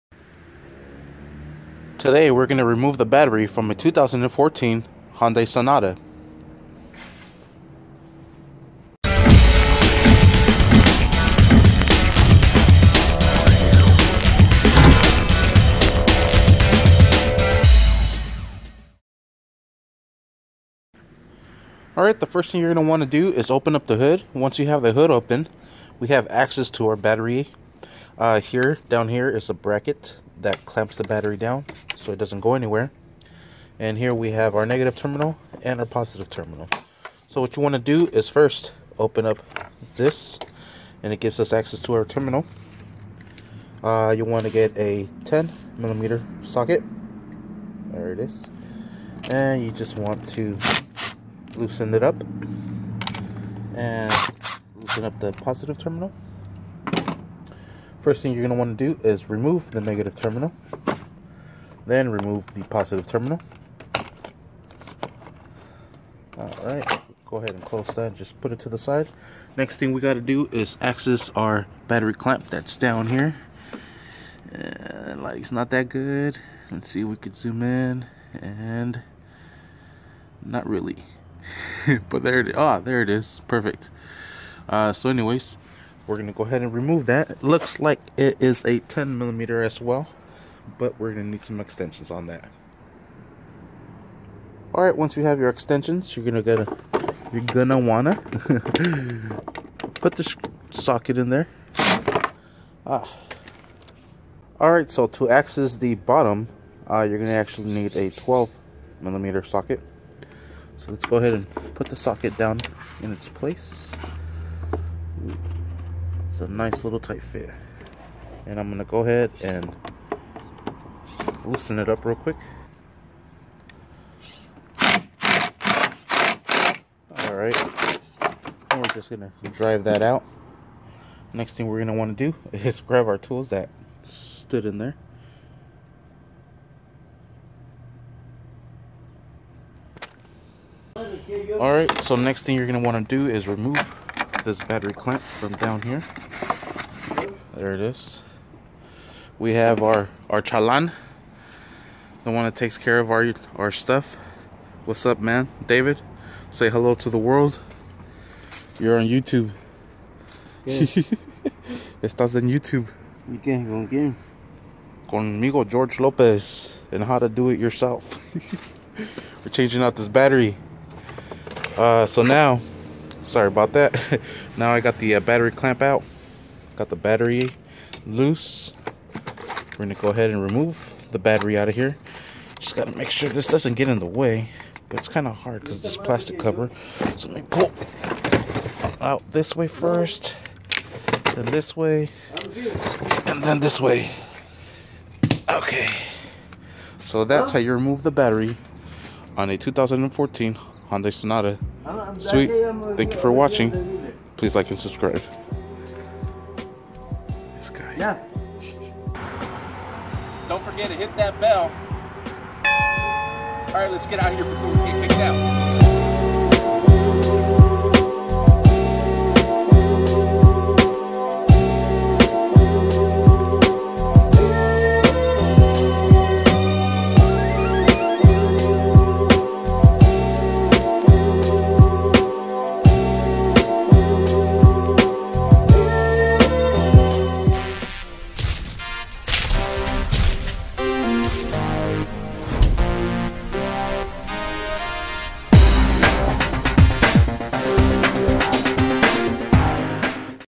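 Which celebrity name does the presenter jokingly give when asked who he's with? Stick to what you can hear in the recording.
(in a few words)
George Lopez.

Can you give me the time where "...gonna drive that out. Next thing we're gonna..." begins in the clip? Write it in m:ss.
2:09.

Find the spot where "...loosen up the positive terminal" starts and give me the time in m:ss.
0:54.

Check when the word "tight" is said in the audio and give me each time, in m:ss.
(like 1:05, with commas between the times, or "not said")
1:56.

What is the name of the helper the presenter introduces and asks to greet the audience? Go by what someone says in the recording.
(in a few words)
David.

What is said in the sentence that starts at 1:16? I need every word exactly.
Let's see if we could zoom in.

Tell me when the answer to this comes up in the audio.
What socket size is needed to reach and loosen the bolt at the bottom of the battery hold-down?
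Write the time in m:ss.
1:48.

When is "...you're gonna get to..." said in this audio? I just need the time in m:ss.
1:36.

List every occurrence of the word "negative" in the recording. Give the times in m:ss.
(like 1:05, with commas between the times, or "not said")
0:34, 0:59.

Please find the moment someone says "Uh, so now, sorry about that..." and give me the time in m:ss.
2:51.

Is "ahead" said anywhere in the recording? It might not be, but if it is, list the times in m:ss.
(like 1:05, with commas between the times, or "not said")
1:07, 1:26, 1:51, 1:58, 3:00.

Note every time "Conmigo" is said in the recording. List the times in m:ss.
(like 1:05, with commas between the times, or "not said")
2:45.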